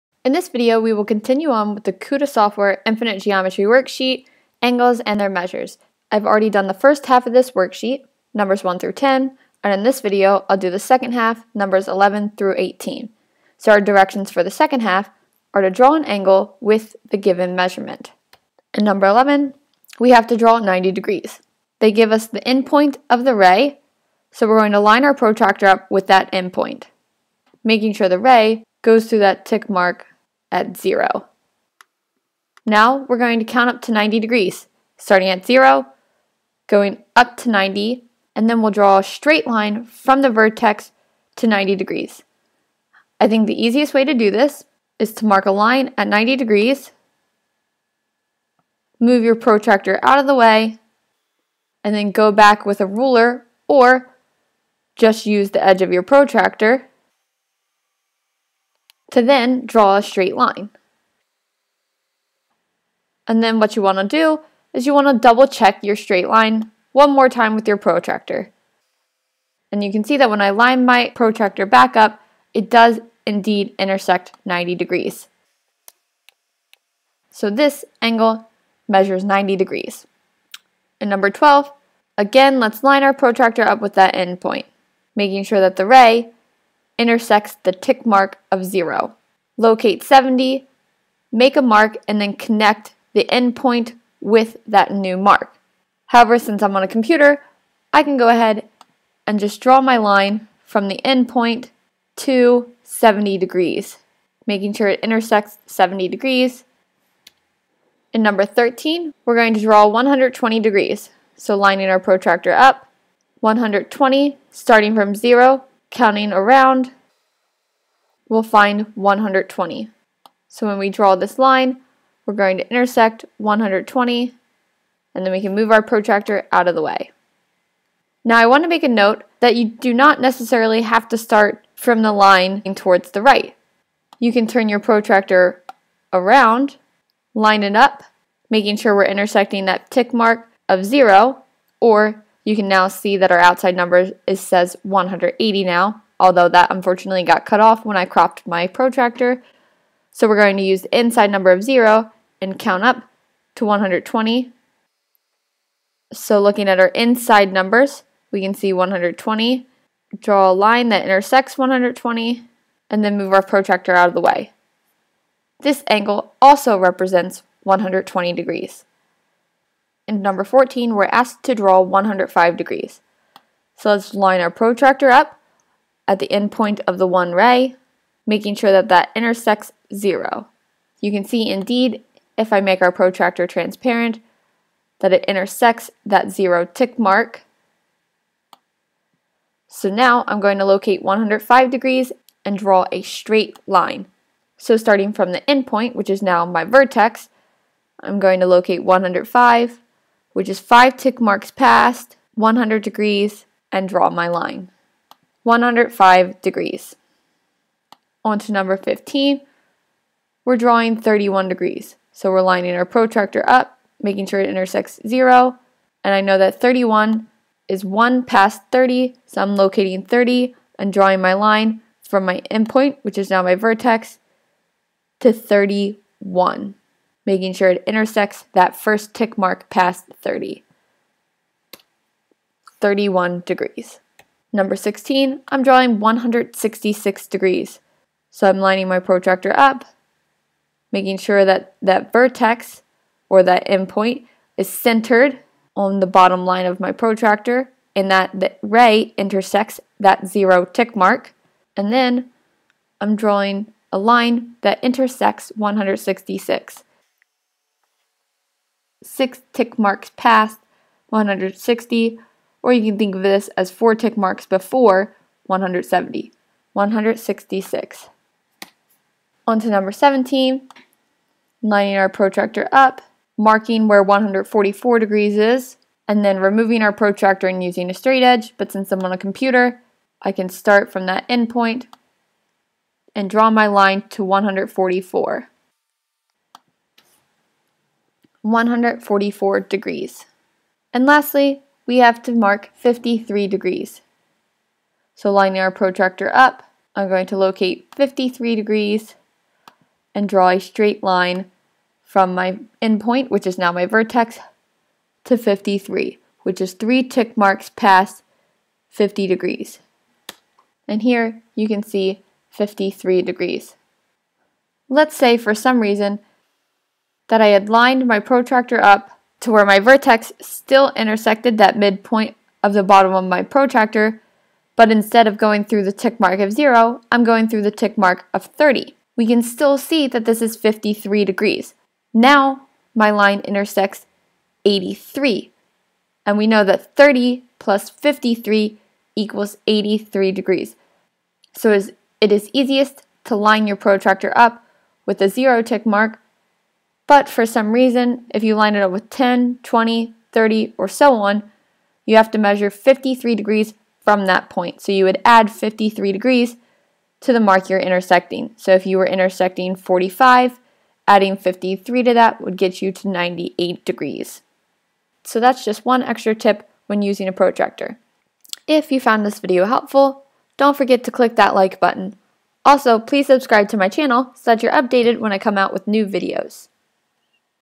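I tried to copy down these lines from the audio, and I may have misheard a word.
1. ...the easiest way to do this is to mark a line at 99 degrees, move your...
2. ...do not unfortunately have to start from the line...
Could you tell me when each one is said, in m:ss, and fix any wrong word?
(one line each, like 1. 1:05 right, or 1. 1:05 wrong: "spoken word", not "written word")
1. 0:43 wrong: "90", not "99"
2. 2:09 wrong: "necessarily", not "unfortunately".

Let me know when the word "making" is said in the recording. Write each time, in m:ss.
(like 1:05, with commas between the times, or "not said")
0:27, 1:25, 1:44, 2:18, 2:58, 3:34, 3:47, 4:00.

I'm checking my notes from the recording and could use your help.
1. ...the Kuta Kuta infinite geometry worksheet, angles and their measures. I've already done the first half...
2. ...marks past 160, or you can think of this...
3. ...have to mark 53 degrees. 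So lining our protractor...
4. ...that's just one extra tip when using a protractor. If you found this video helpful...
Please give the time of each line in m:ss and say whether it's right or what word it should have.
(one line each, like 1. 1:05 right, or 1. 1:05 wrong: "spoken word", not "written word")
1. 0:01 wrong: "Software", not "Kuta"
2. 4:19 right
3. 4:51 right
4. 6:05 right.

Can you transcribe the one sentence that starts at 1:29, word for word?
Locate 70, make a mark, and then connect the endpoint with that new mark.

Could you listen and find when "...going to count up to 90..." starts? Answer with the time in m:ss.
0:33.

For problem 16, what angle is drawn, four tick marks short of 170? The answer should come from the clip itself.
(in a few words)
166 degrees.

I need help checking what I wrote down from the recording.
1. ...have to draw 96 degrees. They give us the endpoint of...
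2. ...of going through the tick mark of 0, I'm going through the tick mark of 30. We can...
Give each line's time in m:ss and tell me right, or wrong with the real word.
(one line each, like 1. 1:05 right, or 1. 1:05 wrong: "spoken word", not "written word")
1. 0:20 wrong: "90", not "96"
2. 5:25 right.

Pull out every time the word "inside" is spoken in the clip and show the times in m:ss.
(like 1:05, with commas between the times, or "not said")
2:30, 2:36.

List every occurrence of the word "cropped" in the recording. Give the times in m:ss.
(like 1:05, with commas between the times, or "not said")
2:28.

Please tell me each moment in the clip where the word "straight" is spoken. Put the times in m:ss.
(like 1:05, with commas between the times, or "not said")
0:39, 1:00, 1:05, 3:13, 4:37, 5:00.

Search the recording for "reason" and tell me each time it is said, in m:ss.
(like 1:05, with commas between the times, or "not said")
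5:15, 5:47.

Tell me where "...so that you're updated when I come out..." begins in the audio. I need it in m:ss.
6:14.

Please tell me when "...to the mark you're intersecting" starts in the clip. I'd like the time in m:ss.
5:57.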